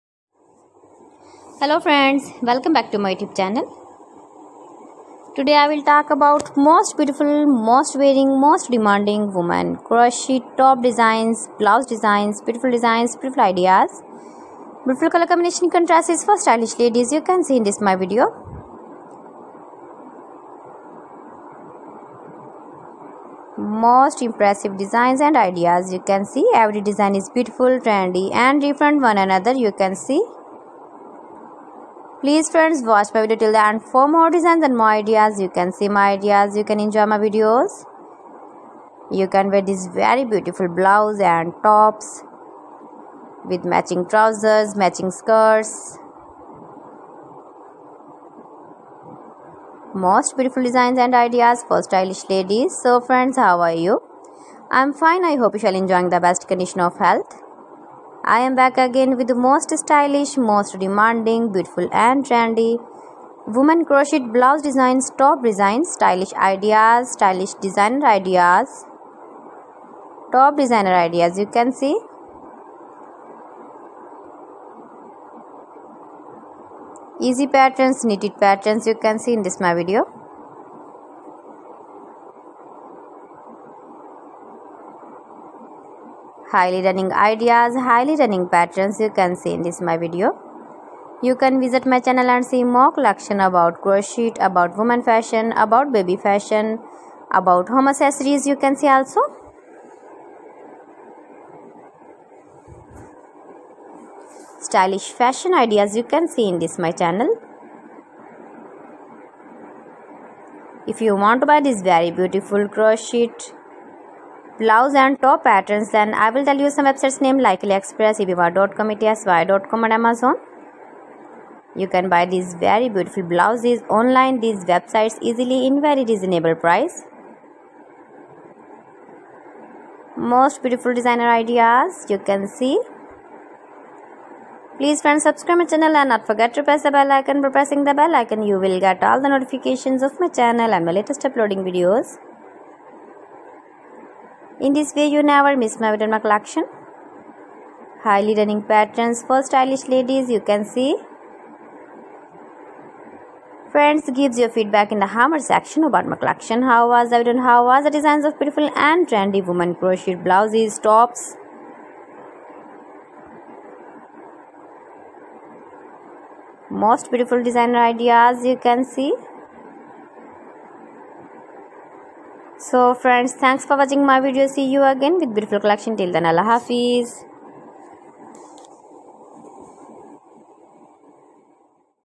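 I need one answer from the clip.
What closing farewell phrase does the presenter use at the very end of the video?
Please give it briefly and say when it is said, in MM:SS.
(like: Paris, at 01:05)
Allah Hafiz, at 02:56.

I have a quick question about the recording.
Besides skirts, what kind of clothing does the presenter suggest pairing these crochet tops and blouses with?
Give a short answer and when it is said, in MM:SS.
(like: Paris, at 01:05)
Matching trousers, at 00:43.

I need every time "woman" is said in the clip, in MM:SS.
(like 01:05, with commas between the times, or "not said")
00:09, 01:03, 01:34, 02:39.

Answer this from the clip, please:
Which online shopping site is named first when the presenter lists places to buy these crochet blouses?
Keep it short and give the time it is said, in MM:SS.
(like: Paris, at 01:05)
AliExpress, at 01:57.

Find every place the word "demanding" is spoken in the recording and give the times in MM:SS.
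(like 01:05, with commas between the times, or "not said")
00:08, 01:00.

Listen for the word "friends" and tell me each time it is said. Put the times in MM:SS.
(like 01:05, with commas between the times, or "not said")
00:01, 00:32, 00:53, 02:15, 02:33, 02:52.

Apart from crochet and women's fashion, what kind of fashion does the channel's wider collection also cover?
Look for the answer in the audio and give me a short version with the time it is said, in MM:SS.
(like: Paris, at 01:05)
Baby fashion, at 01:35.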